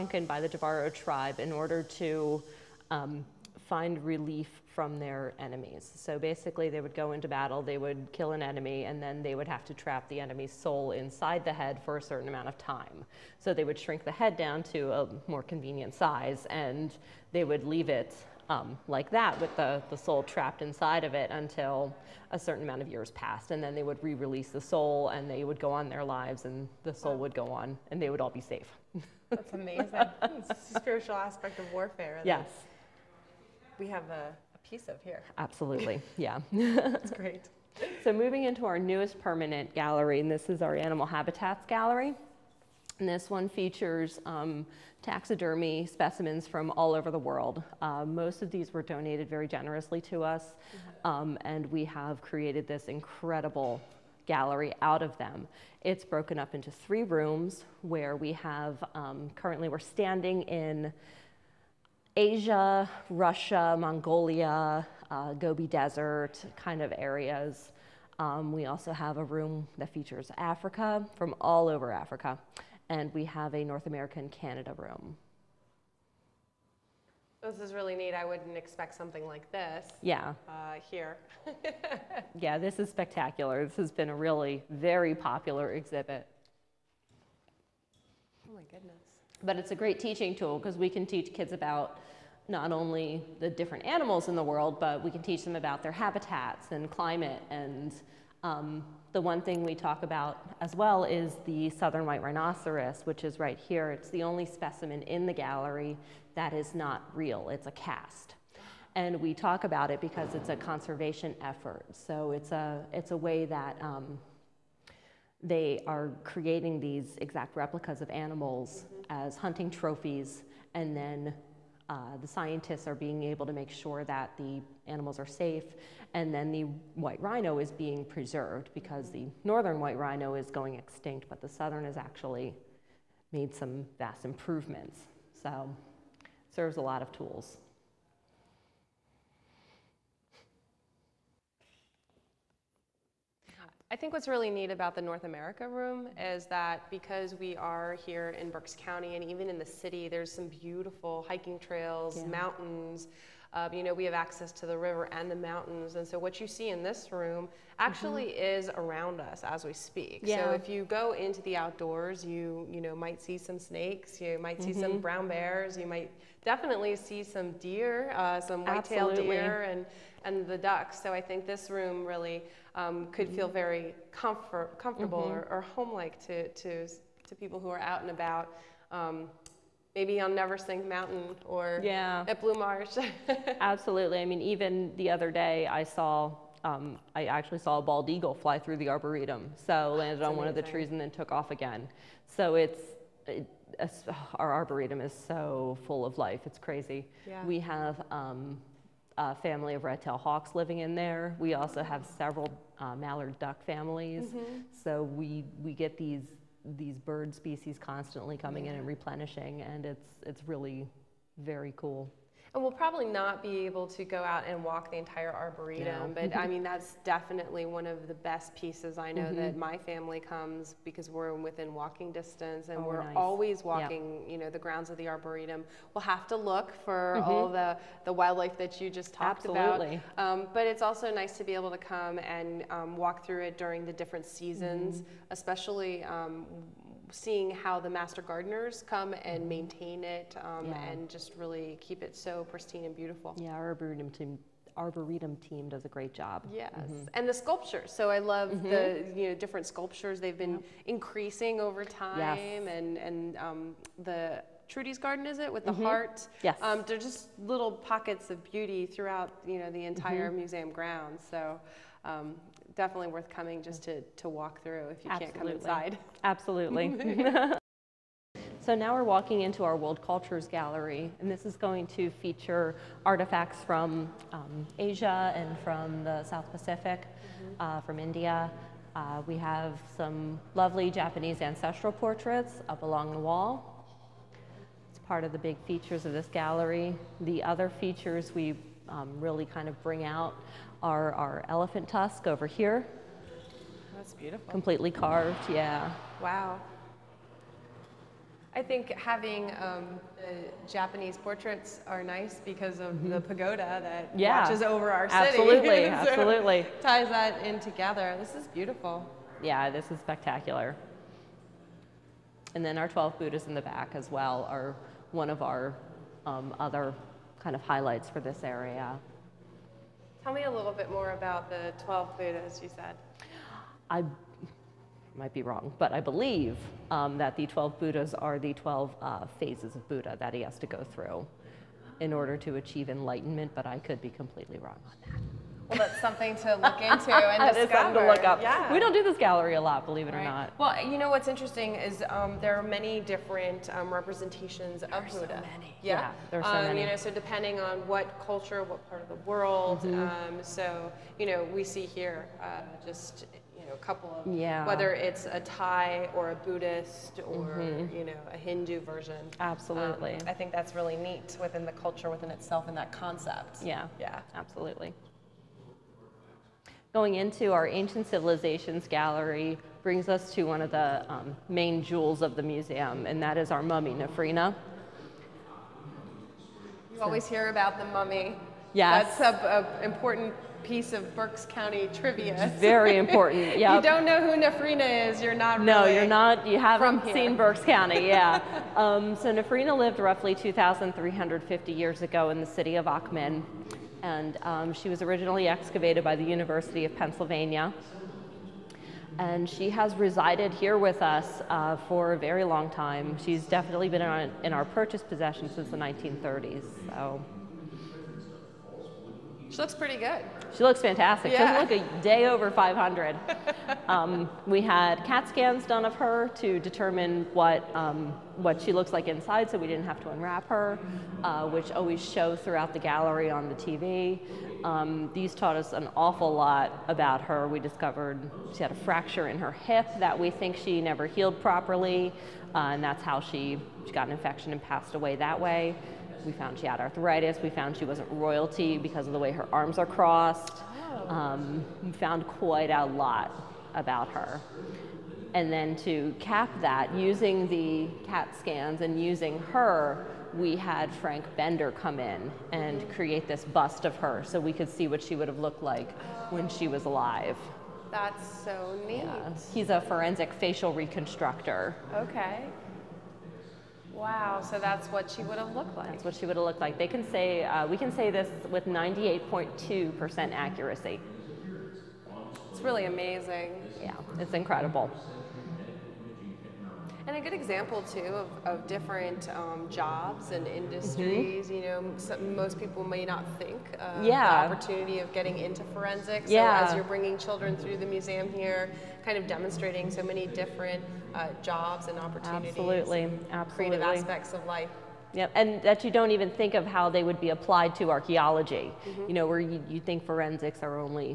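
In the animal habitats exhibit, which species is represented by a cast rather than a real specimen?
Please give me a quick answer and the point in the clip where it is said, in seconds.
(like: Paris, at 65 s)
southern white rhinoceros, at 101 s.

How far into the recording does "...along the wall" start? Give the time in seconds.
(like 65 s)
282 s.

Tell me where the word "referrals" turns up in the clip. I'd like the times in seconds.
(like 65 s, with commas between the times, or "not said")
not said.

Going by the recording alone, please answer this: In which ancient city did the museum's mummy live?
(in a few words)
Akhmim.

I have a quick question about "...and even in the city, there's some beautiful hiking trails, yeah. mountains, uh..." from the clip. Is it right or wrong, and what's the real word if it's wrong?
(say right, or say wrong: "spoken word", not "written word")
right.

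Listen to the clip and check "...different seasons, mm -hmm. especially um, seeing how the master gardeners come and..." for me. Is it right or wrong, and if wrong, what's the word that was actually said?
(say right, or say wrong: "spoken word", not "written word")
right.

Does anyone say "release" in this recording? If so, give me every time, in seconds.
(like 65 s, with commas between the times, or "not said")
24 s.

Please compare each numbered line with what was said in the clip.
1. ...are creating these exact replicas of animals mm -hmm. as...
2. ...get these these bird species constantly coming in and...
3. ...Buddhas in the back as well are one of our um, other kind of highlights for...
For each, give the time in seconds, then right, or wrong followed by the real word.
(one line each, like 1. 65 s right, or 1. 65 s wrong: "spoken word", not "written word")
1. 115 s right
2. 205 s right
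3. 313 s right.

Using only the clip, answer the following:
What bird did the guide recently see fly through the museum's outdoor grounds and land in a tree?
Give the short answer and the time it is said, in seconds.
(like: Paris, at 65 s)
bald eagle, at 187 s.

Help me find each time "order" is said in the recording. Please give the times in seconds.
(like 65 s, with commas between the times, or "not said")
1 s, 332 s.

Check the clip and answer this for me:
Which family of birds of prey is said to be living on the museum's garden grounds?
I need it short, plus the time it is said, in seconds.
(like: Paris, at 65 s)
red-tailed hawks, at 199 s.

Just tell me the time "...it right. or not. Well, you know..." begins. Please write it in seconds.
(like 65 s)
340 s.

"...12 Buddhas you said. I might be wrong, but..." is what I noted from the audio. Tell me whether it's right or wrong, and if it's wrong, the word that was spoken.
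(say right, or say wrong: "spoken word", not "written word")
right.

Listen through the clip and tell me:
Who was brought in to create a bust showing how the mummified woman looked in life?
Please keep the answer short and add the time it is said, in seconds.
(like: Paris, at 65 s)
Frank Bender, at 450 s.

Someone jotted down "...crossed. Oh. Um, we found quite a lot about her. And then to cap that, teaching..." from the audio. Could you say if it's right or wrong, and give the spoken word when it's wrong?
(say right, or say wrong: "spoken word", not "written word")
wrong: "using", not "teaching".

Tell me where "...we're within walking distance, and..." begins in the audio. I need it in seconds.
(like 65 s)
221 s.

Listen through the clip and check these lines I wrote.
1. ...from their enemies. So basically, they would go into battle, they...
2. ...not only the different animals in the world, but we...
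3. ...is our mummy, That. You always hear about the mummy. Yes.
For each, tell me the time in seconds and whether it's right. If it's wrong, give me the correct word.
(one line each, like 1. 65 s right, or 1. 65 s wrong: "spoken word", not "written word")
1. 4 s right
2. 92 s right
3. 373 s wrong: "Nefrina", not "That".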